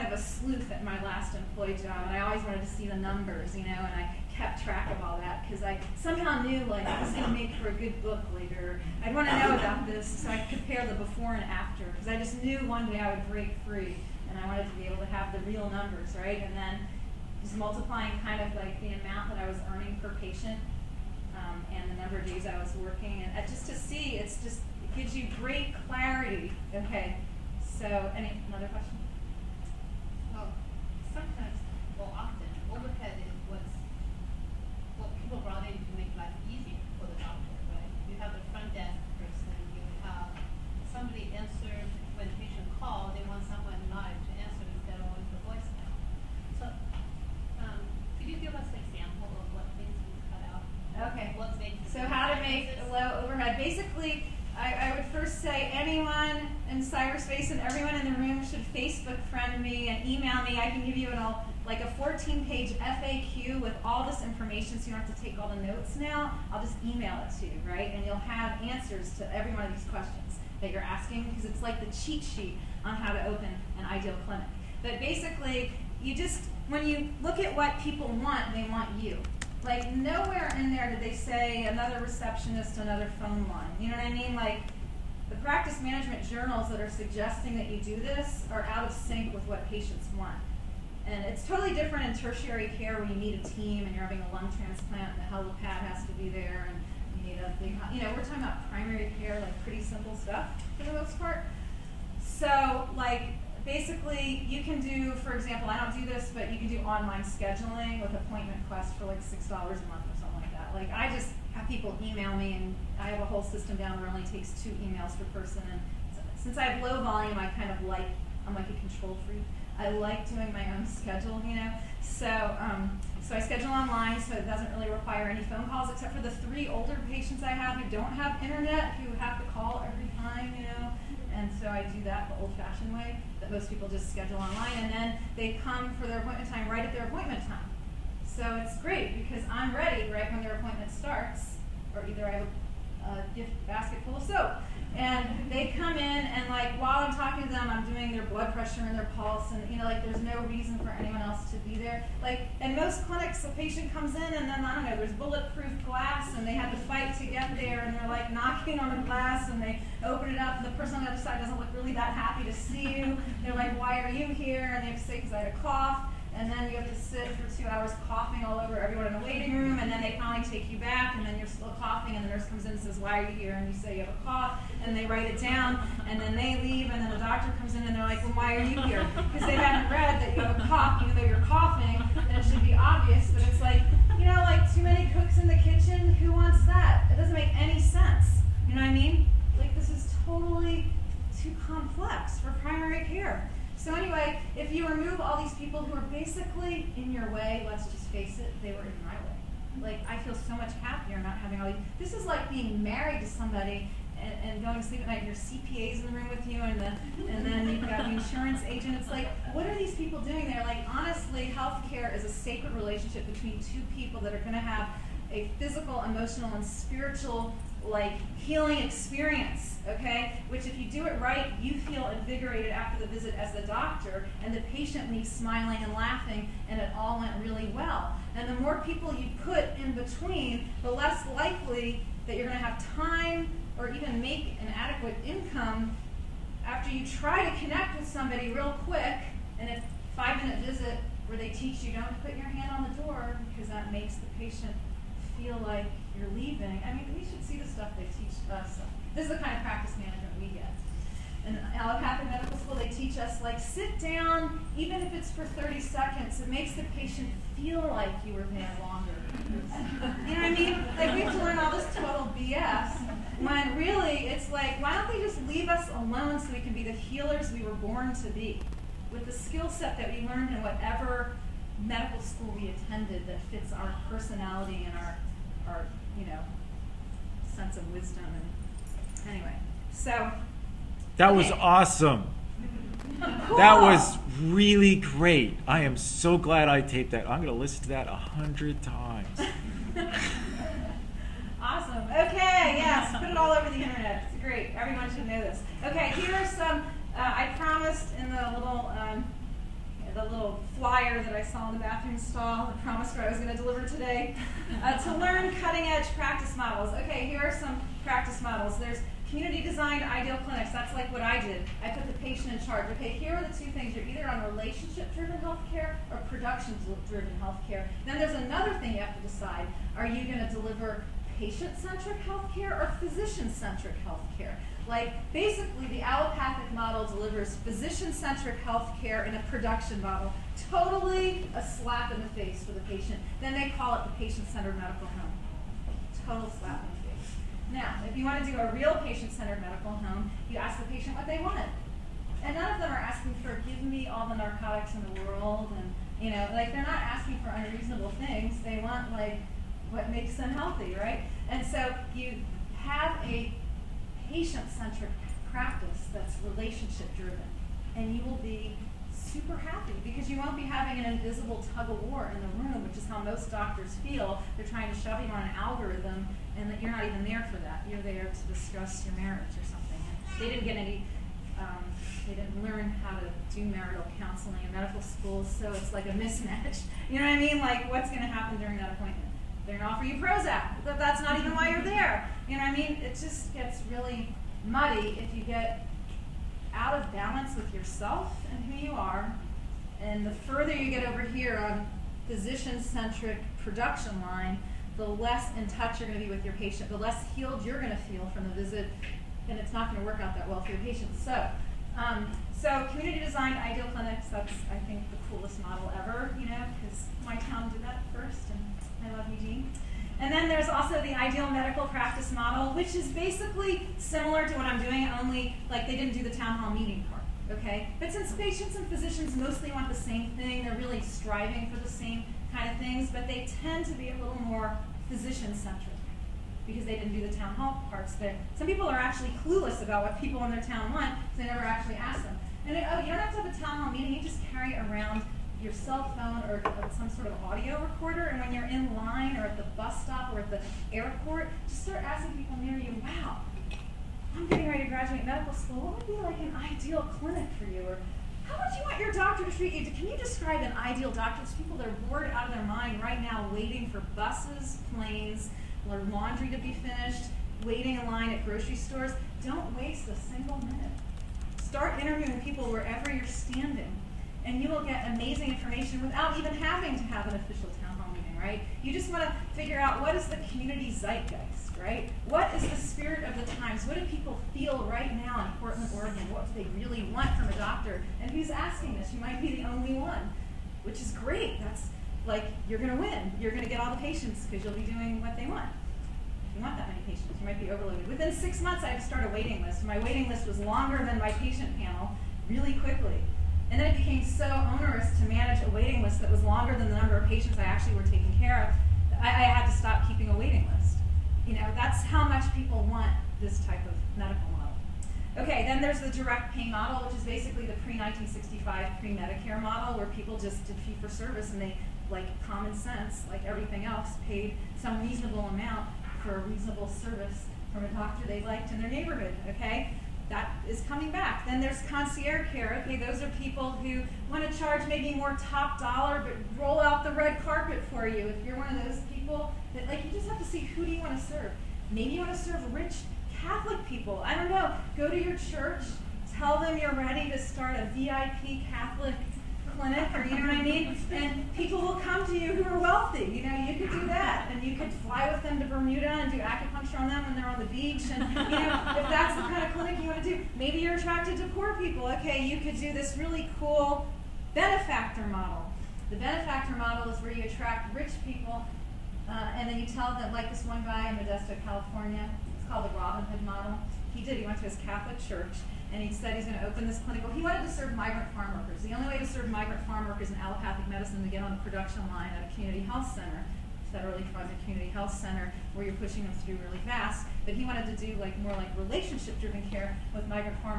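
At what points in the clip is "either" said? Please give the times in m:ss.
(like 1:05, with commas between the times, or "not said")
2:22, 5:14.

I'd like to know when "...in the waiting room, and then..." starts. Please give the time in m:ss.
2:49.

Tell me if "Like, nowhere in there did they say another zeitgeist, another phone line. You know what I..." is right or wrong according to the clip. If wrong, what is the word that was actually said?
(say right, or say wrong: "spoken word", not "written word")
wrong: "receptionist", not "zeitgeist".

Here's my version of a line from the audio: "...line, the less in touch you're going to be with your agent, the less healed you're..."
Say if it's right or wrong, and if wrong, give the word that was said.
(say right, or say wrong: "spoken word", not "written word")
wrong: "patient", not "agent".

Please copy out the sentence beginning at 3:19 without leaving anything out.
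Like I feel so much happier not having all these.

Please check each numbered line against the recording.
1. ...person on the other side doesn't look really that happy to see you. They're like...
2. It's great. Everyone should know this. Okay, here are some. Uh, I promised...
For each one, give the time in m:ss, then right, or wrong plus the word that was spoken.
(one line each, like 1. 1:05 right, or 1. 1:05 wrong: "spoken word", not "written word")
1. 2:40 right
2. 4:54 right.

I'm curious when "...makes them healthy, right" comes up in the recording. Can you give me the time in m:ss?
5:50.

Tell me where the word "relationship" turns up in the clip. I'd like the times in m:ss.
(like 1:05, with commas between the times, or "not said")
3:32, 5:14, 5:56, 9:38.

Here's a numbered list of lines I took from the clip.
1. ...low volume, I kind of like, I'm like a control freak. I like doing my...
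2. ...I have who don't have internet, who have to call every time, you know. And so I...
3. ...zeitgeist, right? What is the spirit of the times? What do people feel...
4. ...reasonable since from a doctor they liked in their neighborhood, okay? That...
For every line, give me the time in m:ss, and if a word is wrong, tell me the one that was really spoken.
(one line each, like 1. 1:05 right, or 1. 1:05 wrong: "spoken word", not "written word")
1. 1:56 right
2. 2:07 right
3. 7:50 right
4. 8:36 wrong: "service", not "since".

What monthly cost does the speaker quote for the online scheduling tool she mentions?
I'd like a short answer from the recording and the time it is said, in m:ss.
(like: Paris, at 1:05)
$6, at 1:49.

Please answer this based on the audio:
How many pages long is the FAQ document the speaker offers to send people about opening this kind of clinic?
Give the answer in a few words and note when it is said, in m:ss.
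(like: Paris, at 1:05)
14, at 1:01.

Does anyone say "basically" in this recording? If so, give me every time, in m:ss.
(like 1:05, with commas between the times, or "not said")
0:53, 1:14, 1:43, 3:16, 5:25, 6:53, 8:27.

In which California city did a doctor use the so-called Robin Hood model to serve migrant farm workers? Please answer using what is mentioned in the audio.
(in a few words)
Modesto.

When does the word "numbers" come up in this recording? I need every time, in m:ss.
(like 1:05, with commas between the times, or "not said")
0:02, 0:15, 0:21, 8:16.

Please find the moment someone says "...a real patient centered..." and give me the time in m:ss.
5:38.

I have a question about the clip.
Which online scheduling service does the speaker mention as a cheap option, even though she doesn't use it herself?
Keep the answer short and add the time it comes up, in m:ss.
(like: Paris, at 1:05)
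AppointmentQuest, at 1:48.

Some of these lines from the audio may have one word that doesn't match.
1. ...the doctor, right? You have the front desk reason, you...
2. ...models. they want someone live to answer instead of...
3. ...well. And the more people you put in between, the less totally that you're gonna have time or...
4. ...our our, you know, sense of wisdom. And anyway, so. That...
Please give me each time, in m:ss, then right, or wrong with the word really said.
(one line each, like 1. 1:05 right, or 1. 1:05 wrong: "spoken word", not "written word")
1. 0:37 wrong: "person", not "reason"
2. 0:42 wrong: "calls", not "models"
3. 3:47 wrong: "likely", not "totally"
4. 4:34 right.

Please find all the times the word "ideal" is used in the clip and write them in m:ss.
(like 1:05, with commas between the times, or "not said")
1:13, 5:10, 6:43, 6:51, 7:26, 7:30.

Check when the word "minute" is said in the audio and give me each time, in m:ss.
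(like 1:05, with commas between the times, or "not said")
4:00, 7:40.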